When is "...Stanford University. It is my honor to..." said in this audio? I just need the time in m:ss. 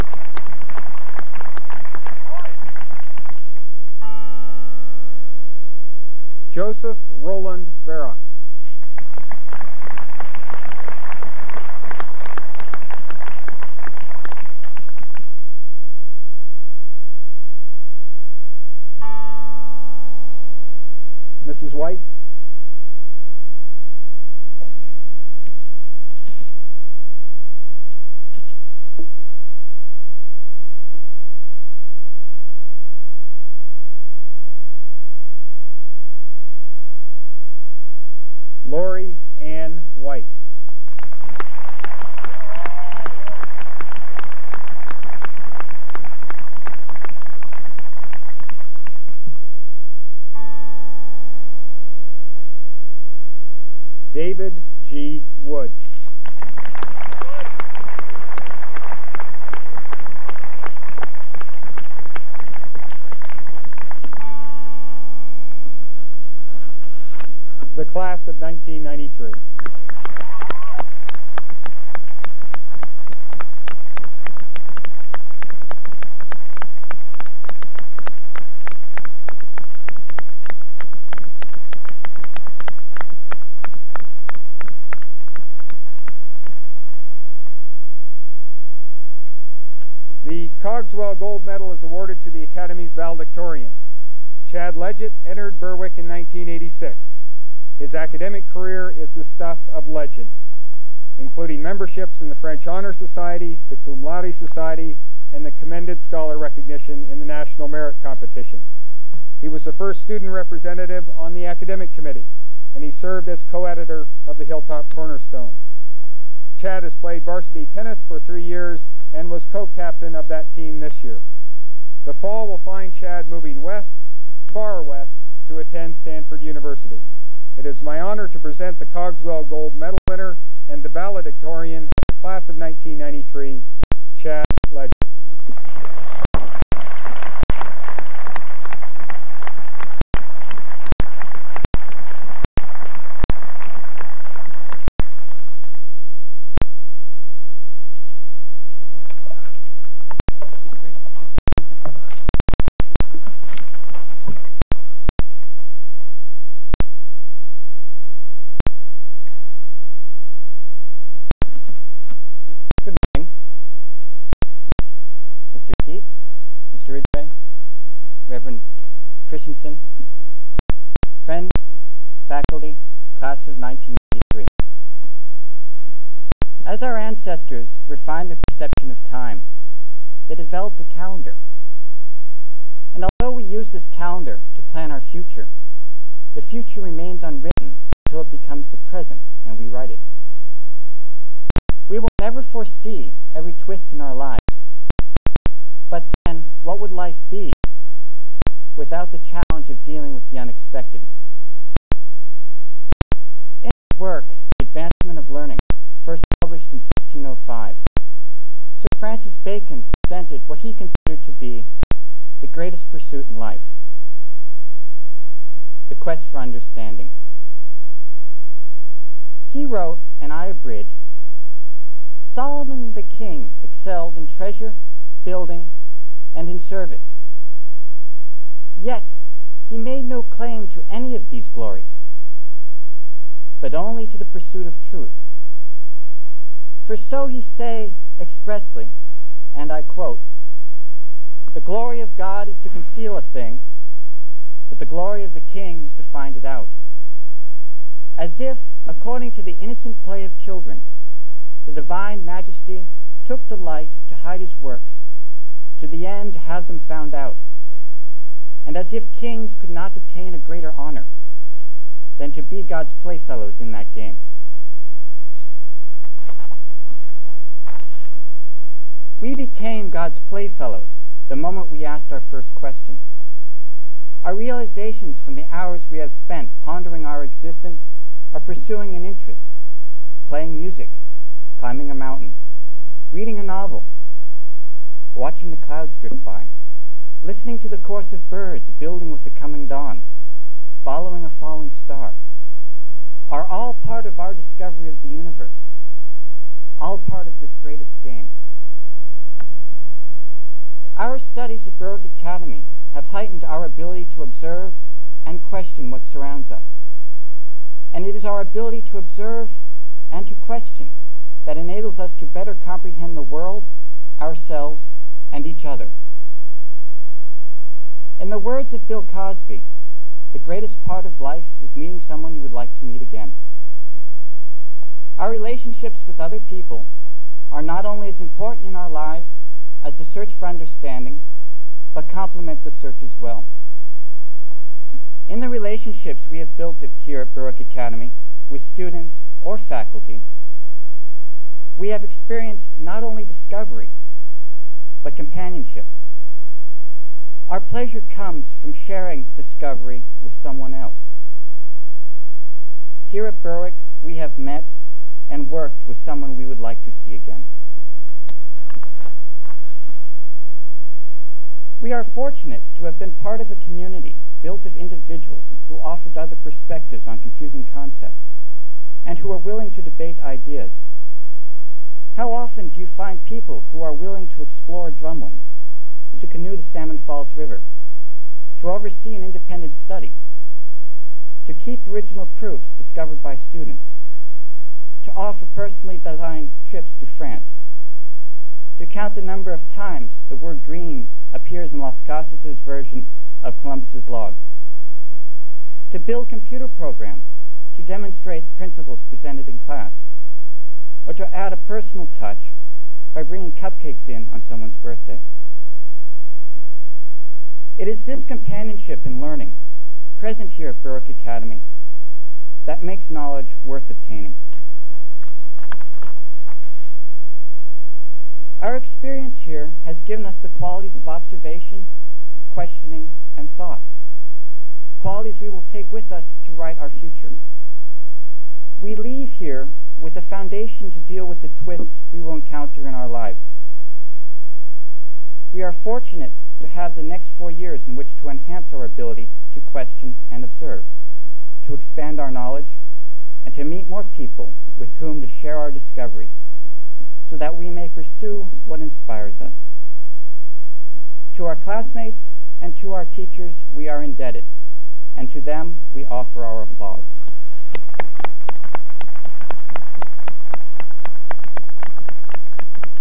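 2:05.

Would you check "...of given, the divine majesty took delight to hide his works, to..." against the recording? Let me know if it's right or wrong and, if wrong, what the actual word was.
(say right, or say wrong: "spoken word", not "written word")
wrong: "children", not "given".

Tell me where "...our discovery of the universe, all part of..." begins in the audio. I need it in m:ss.
4:54.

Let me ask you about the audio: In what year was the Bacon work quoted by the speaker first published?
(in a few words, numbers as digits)
1605.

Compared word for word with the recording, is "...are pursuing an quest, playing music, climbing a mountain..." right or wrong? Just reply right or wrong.
wrong.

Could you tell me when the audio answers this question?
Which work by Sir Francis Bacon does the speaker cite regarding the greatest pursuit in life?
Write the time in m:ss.
3:24.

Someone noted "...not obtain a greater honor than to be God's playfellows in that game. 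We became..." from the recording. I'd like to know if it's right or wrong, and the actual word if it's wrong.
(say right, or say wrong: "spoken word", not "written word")
right.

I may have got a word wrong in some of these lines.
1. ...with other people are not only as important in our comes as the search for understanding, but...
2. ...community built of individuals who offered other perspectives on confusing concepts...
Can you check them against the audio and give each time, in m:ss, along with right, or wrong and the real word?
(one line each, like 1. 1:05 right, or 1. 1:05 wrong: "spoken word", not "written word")
1. 5:26 wrong: "lives", not "comes"
2. 6:03 right.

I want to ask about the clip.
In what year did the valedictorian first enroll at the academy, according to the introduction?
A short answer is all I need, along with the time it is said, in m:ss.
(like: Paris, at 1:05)
1986, at 1:36.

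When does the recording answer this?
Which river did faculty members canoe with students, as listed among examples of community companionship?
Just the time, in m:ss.
6:16.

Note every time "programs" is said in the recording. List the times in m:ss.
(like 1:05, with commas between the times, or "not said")
6:36.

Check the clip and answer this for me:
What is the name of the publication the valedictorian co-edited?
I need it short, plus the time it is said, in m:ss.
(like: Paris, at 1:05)
Hilltop Cornerstone, at 1:54.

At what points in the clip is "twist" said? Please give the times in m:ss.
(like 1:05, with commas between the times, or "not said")
3:13, 7:11.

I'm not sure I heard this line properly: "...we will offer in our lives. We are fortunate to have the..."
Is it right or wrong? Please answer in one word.
wrong.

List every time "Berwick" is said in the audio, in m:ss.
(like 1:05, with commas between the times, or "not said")
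1:35, 5:01, 5:37, 5:53, 6:50.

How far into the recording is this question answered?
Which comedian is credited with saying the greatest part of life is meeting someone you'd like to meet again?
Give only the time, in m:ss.
5:18.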